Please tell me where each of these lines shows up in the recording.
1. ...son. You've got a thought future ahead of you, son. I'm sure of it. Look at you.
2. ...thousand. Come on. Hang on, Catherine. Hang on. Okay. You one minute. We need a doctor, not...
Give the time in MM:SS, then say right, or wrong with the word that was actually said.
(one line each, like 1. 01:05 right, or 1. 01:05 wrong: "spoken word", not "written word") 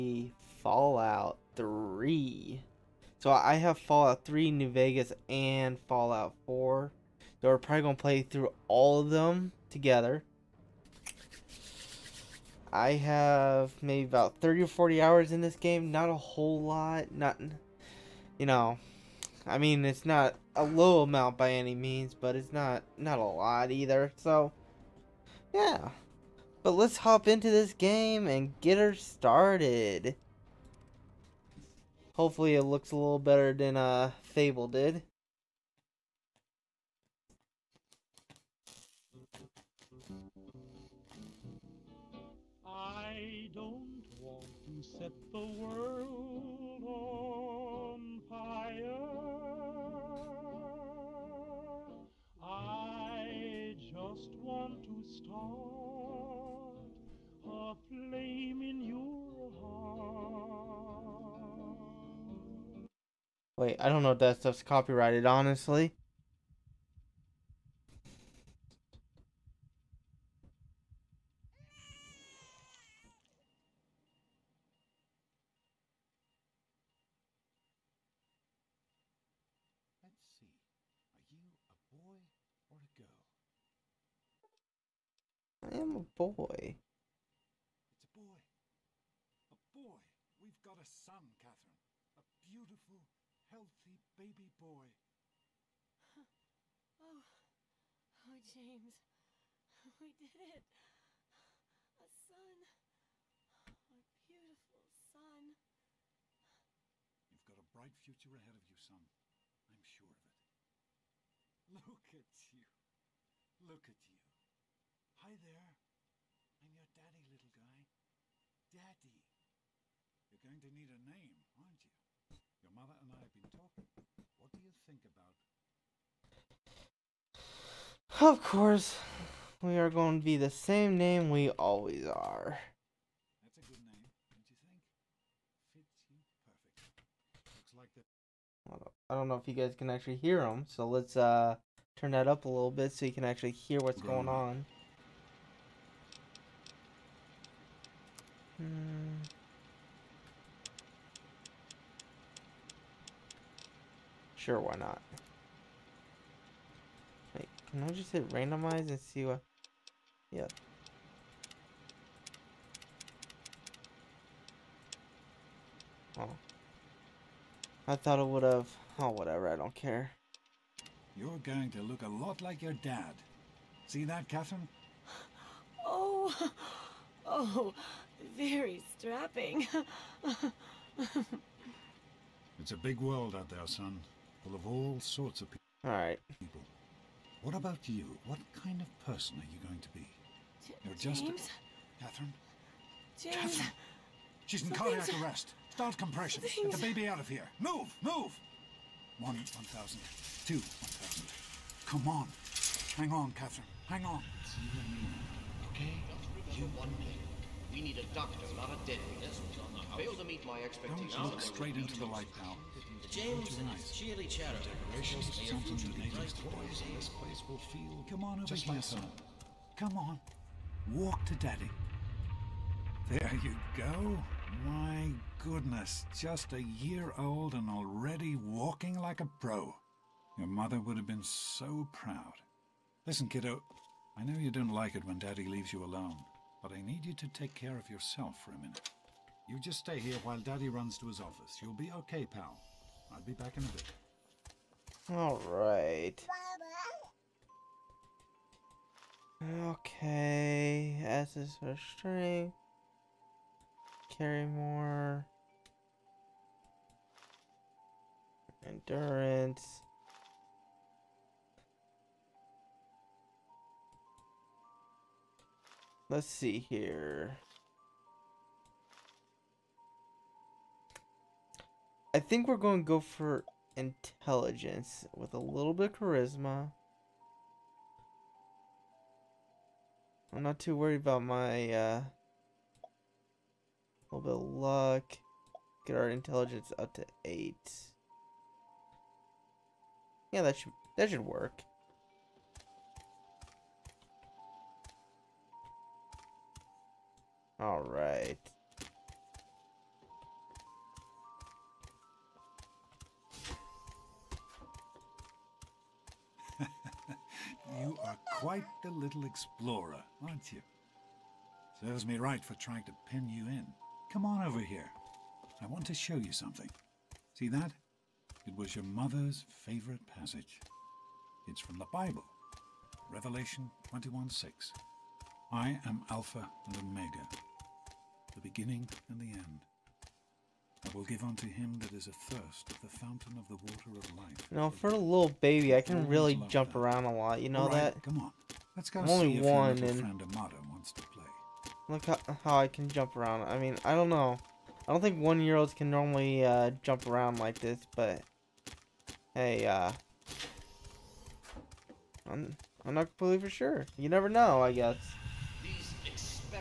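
1. 01:45 wrong: "bright", not "thought"
2. 03:20 right.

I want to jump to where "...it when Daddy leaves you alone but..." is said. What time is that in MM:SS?
03:54.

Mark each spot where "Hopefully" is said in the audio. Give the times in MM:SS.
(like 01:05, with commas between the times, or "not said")
00:32.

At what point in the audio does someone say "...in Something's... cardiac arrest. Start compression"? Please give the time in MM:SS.
03:14.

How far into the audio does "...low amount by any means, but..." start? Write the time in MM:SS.
00:20.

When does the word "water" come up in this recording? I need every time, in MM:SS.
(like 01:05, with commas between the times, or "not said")
05:33.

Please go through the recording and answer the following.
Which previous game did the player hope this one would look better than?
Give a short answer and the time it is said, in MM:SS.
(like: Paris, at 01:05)
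Fable, at 00:34.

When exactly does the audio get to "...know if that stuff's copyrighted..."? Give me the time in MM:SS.
01:04.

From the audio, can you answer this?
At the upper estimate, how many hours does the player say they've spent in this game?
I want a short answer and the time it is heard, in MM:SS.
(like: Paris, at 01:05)
40, at 00:14.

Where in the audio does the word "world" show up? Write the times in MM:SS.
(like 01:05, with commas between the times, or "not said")
00:45, 03:03.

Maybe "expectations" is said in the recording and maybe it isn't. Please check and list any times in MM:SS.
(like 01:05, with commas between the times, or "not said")
03:30.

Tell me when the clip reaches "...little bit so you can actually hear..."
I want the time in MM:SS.
02:22.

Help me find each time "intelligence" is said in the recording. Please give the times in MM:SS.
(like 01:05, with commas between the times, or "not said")
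04:33, 04:46.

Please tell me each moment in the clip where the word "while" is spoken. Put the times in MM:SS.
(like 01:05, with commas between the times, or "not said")
04:00.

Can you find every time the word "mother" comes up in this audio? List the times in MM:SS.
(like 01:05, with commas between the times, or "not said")
02:02, 03:50, 05:18.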